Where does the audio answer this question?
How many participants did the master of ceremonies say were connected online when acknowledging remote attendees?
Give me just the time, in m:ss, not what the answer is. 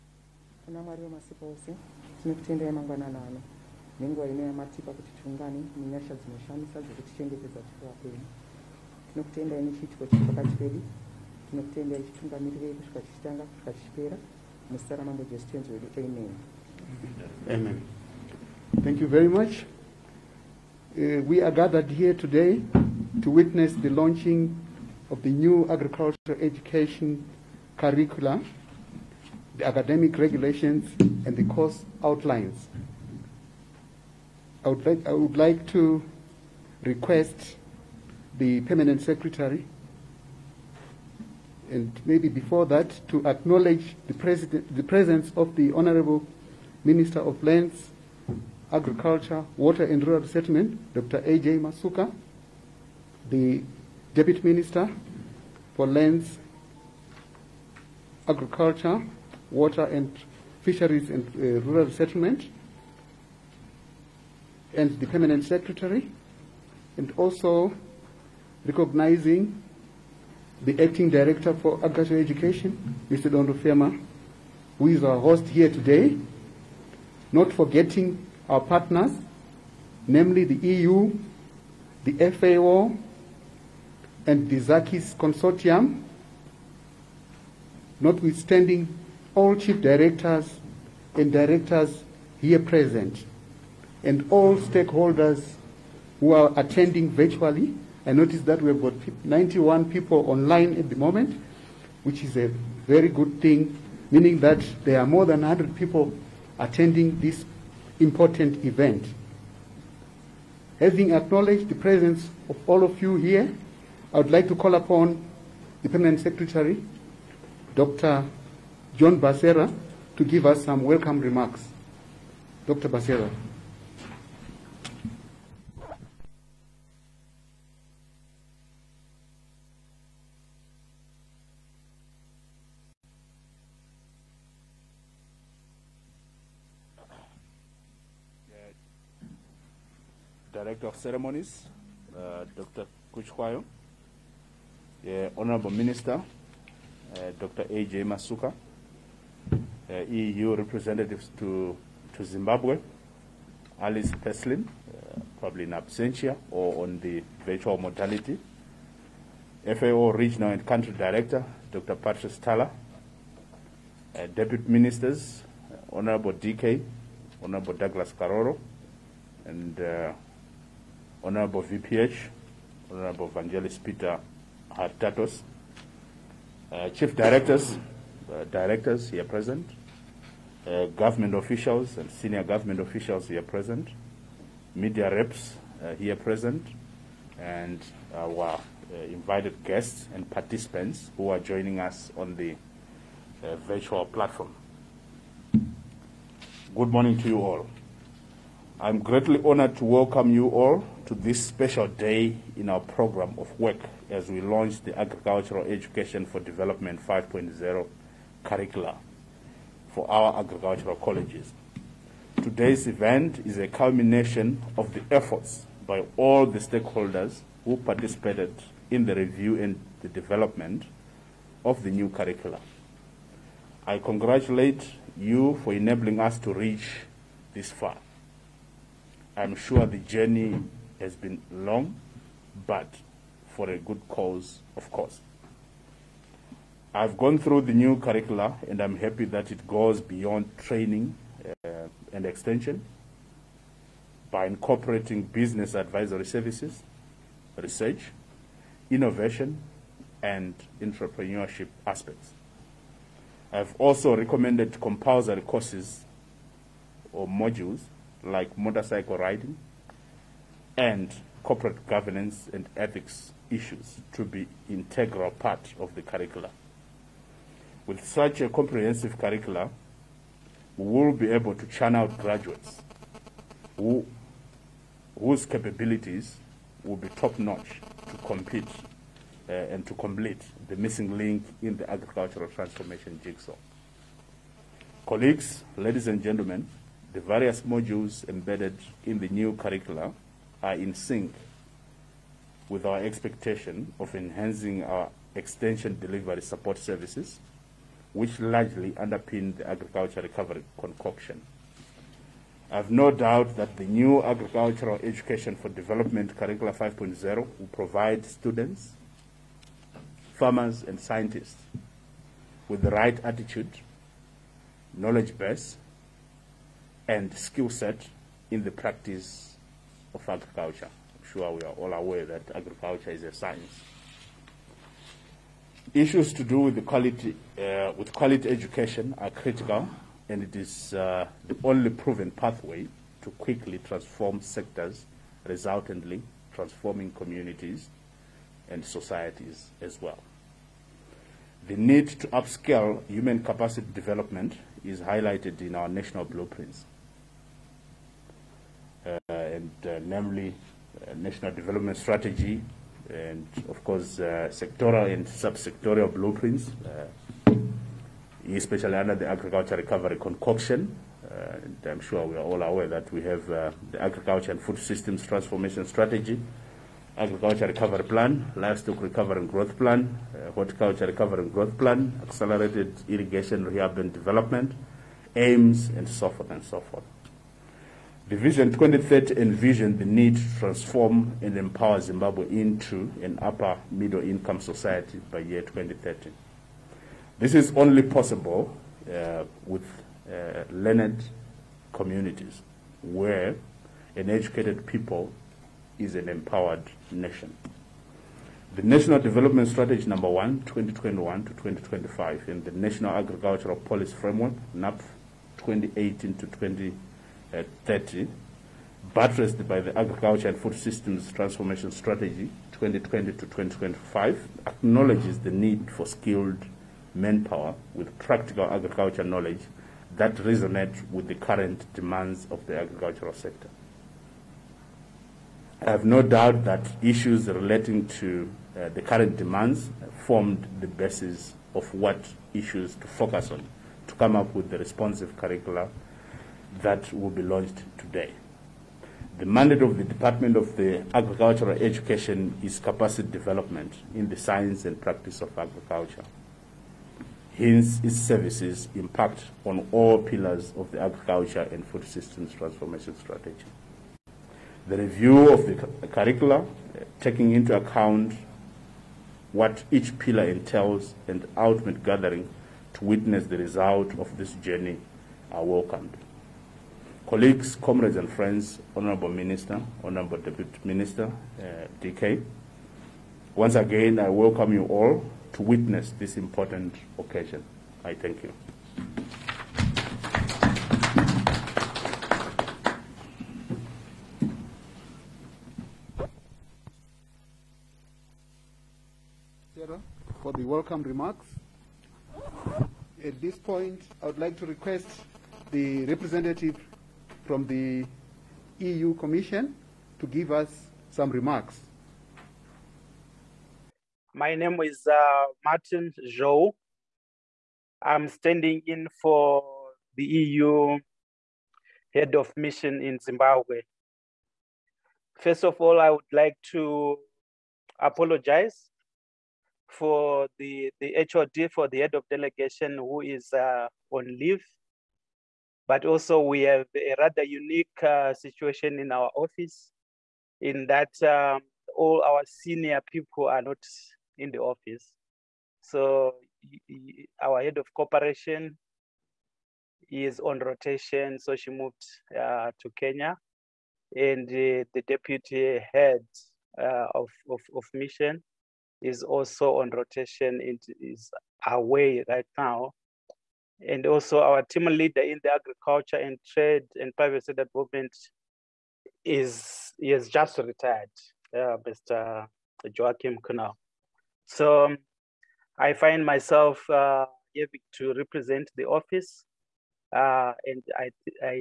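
1:39.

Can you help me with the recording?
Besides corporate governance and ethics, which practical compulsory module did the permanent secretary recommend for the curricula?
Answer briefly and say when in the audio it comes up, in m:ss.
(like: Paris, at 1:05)
motorcycle riding, at 4:18.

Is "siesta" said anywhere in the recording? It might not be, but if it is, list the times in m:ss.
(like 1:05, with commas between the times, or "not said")
not said.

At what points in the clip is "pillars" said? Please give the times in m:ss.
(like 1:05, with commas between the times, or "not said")
7:30, 7:40.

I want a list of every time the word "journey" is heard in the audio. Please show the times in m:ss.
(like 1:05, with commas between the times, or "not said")
3:49, 7:44.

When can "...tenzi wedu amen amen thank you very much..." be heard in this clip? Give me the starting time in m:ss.
0:15.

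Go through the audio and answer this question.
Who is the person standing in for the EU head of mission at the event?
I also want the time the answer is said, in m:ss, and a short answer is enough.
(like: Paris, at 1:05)
Martin Zhou, at 8:25.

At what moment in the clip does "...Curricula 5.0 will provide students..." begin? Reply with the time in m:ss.
5:06.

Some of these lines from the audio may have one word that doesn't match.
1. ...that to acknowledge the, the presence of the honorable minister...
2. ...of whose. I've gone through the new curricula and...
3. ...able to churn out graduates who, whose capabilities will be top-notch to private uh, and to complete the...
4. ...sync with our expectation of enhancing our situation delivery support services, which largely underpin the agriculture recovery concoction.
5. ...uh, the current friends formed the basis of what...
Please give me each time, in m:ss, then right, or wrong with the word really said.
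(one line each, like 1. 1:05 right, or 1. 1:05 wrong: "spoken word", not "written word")
1. 0:42 right
2. 3:54 wrong: "course", not "whose"
3. 4:31 wrong: "compete", not "private"
4. 4:50 wrong: "extension", not "situation"
5. 7:08 wrong: "demands", not "friends".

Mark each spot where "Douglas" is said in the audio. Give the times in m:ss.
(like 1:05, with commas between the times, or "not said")
2:47.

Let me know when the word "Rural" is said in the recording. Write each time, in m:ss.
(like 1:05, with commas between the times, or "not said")
0:50, 1:01.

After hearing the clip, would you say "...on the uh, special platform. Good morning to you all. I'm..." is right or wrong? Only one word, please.
wrong.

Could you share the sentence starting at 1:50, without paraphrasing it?
Having acknowledged the presence of all of you here, I would like to call upon the Permanent Secretary, Dr.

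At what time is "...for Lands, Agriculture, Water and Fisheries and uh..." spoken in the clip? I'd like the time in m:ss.
0:55.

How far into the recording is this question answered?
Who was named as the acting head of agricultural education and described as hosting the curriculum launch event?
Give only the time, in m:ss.
1:13.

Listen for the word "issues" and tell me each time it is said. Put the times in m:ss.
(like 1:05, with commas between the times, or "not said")
4:23, 5:25, 7:07, 7:12.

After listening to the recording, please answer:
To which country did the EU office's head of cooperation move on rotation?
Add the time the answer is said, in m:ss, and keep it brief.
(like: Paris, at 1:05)
Kenya, at 9:02.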